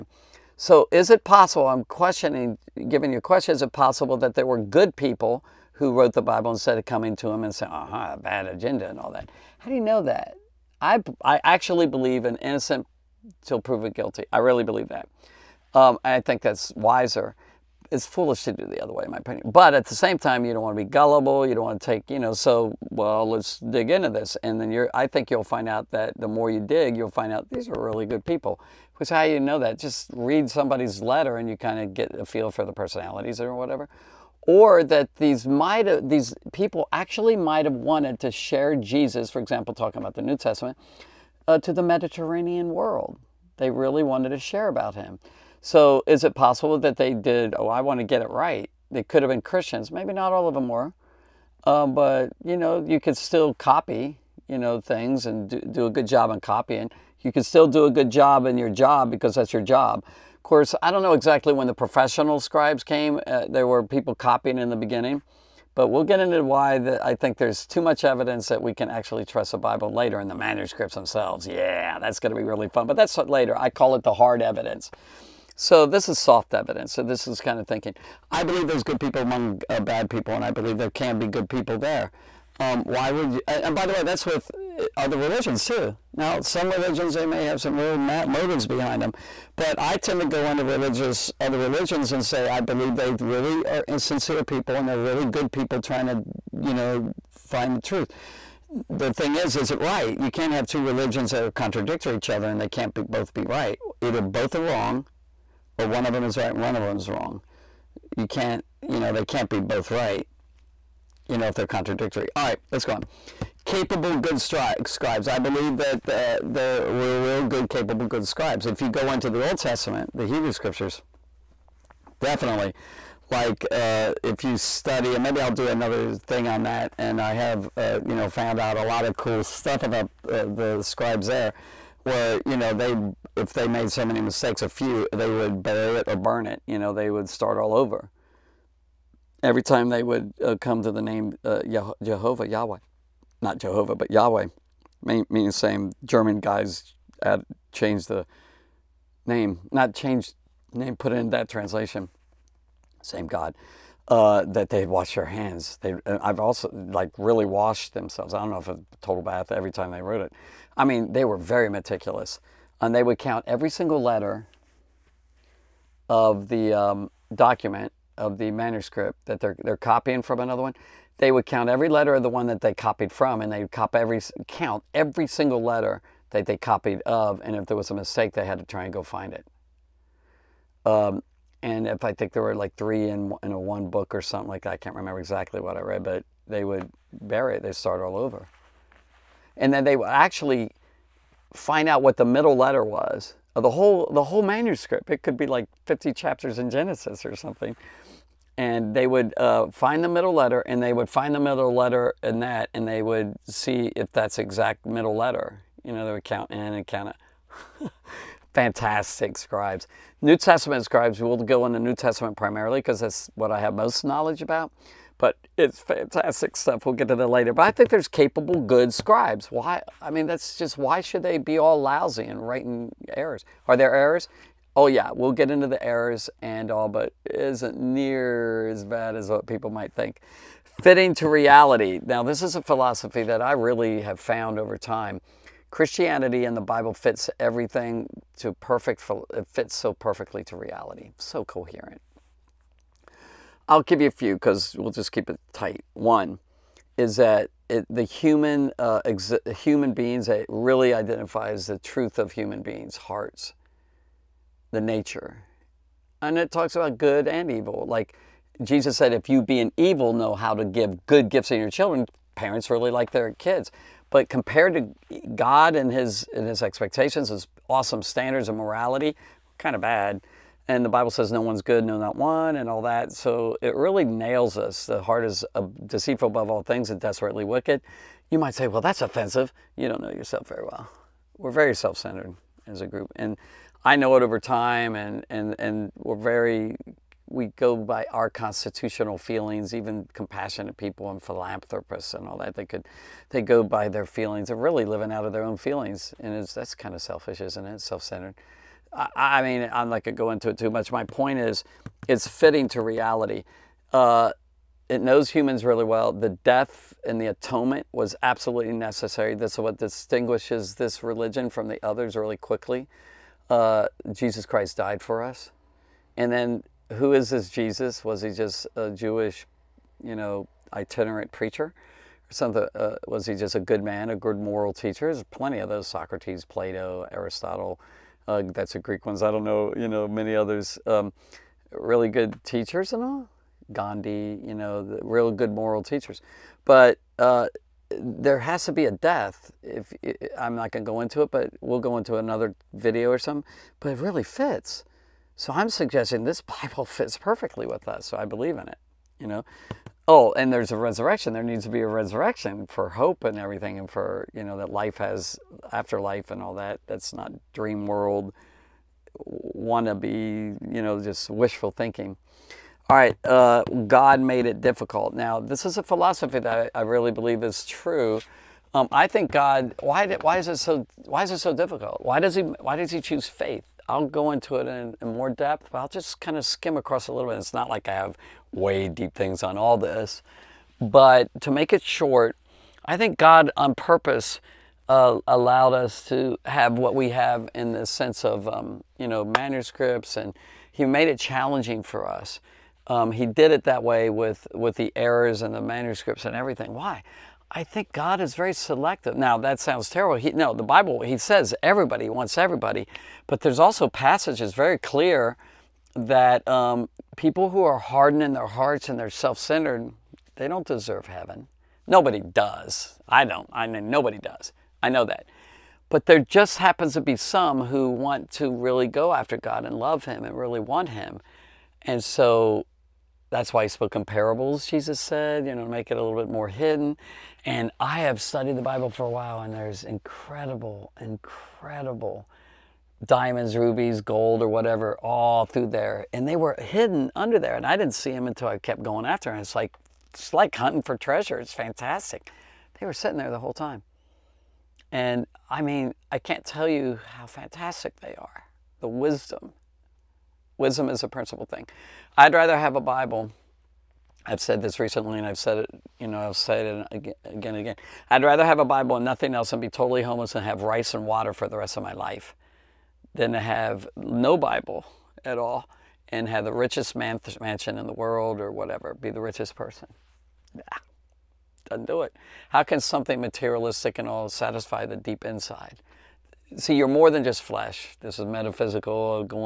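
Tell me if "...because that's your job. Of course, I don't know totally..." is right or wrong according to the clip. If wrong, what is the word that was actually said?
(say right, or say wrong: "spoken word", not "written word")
wrong: "exactly", not "totally".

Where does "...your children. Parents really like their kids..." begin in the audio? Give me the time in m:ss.
4:21.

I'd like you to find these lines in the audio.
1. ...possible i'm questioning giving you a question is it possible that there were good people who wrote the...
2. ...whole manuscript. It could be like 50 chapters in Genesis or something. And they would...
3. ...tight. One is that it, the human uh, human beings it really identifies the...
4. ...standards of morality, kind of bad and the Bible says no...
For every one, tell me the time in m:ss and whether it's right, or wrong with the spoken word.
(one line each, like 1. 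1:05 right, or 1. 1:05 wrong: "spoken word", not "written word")
1. 0:01 right
2. 3:14 right
3. 4:05 right
4. 4:28 right.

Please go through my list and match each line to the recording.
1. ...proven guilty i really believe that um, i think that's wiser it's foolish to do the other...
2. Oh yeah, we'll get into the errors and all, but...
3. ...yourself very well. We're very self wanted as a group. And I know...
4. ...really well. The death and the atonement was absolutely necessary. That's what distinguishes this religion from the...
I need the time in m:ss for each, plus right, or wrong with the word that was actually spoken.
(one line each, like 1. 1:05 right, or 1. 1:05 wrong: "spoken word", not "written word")
1. 0:13 right
2. 3:44 right
3. 4:40 wrong: "centered", not "wanted"
4. 5:05 right.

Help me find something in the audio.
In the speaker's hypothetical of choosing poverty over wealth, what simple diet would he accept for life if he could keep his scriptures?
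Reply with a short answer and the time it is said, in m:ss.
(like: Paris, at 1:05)
rice and water, at 7:40.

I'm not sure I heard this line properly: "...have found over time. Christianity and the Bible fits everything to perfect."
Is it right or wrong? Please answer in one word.
right.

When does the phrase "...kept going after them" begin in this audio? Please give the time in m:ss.
7:18.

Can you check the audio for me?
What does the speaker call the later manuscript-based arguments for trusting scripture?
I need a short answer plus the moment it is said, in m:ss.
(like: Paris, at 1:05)
hard evidence, at 1:14.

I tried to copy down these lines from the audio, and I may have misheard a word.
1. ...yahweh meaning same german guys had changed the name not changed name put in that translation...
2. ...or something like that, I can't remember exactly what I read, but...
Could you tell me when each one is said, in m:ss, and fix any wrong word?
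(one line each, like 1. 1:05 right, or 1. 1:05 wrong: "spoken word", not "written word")
1. 2:24 right
2. 3:04 right.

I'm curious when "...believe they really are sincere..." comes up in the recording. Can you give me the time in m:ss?
1:32.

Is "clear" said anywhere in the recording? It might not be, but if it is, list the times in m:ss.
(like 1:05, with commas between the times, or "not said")
6:44.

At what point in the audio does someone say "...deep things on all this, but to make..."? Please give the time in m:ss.
6:18.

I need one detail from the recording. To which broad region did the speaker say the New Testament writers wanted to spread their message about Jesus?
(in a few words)
the Mediterranean world.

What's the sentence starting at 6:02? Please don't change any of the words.
All right, uh, God made it difficult.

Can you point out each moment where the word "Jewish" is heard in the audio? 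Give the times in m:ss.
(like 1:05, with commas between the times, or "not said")
5:18.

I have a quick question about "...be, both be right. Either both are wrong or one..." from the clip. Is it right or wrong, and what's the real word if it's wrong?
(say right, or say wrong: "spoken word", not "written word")
right.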